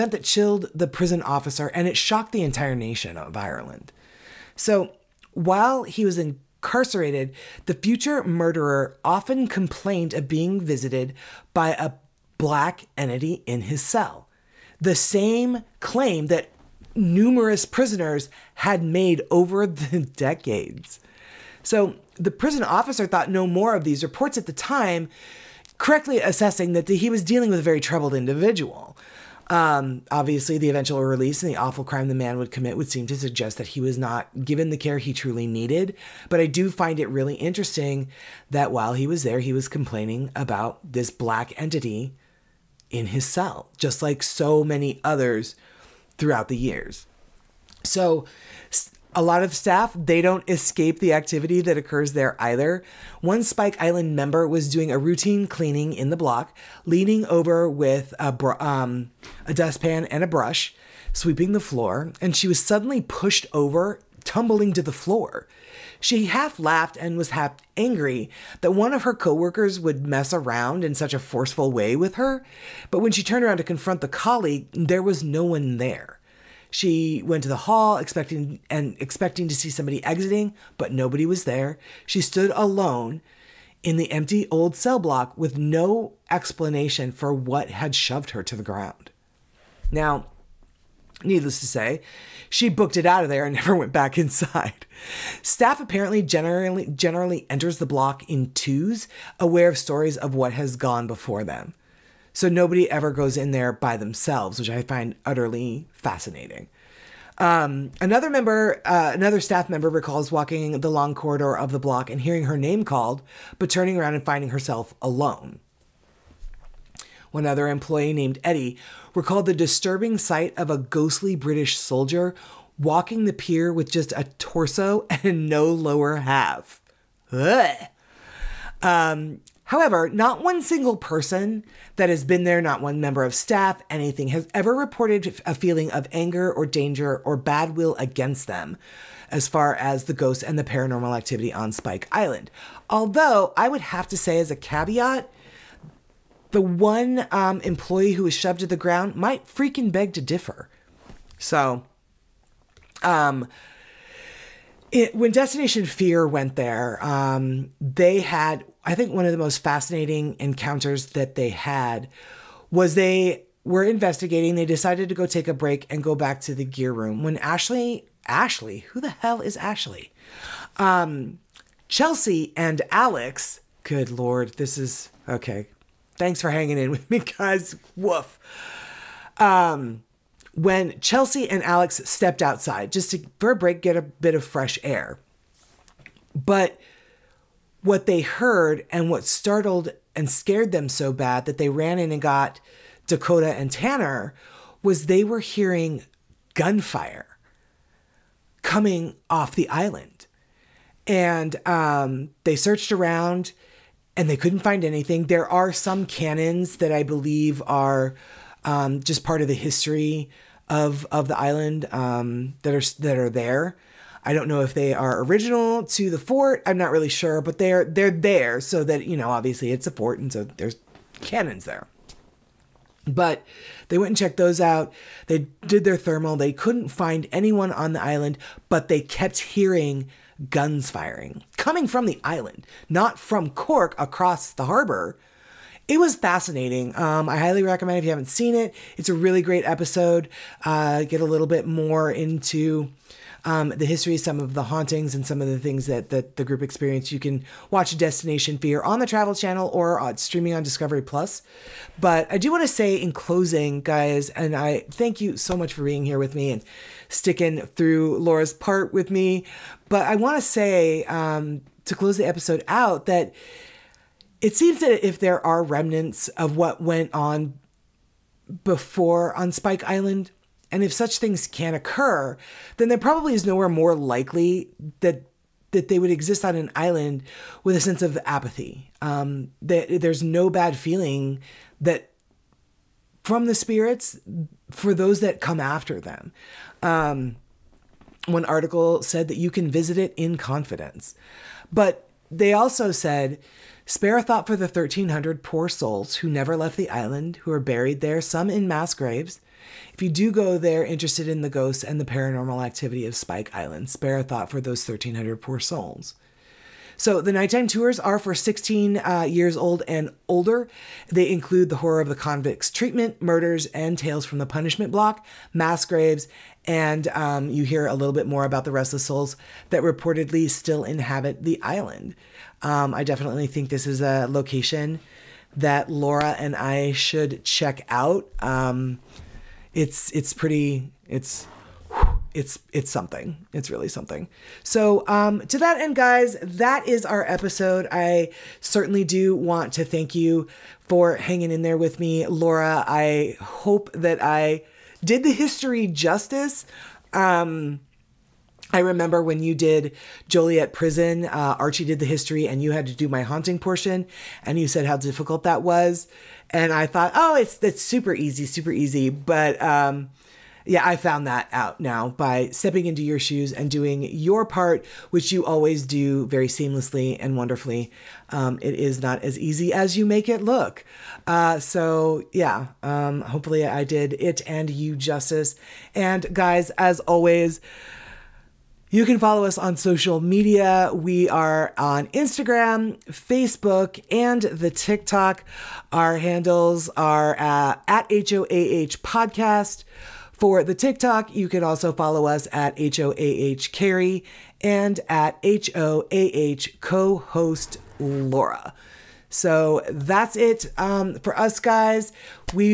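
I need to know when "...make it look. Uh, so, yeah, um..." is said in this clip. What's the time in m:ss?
6:10.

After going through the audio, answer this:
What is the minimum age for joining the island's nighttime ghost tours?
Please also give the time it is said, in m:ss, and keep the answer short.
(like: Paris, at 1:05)
16, at 5:08.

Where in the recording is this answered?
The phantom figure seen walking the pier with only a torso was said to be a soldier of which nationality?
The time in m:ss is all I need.
2:01.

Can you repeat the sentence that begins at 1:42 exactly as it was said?
So nobody ever goes in there by themselves, which I find utterly fascinating.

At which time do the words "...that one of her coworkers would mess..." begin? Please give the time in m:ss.
1:08.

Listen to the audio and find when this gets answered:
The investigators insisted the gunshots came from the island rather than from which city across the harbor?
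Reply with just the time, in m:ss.
3:53.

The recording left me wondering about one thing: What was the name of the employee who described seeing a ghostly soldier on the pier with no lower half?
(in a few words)
Eddie.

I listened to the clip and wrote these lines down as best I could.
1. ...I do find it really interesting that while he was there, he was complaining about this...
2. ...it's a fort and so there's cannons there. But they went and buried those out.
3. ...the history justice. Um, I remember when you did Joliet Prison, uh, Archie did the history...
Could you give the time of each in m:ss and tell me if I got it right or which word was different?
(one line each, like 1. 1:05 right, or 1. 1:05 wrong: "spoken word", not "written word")
1. 0:36 right
2. 3:39 wrong: "checked", not "buried"
3. 5:45 right.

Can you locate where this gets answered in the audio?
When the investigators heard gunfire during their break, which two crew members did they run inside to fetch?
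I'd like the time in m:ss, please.
3:13.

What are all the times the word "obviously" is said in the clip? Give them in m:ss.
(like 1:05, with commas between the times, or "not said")
0:30, 3:39.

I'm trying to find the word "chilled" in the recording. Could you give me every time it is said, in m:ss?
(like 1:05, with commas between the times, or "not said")
0:00.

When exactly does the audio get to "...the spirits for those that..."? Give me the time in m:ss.
4:43.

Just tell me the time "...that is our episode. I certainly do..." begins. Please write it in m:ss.
5:36.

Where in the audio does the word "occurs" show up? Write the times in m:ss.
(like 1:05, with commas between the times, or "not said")
0:51, 4:31.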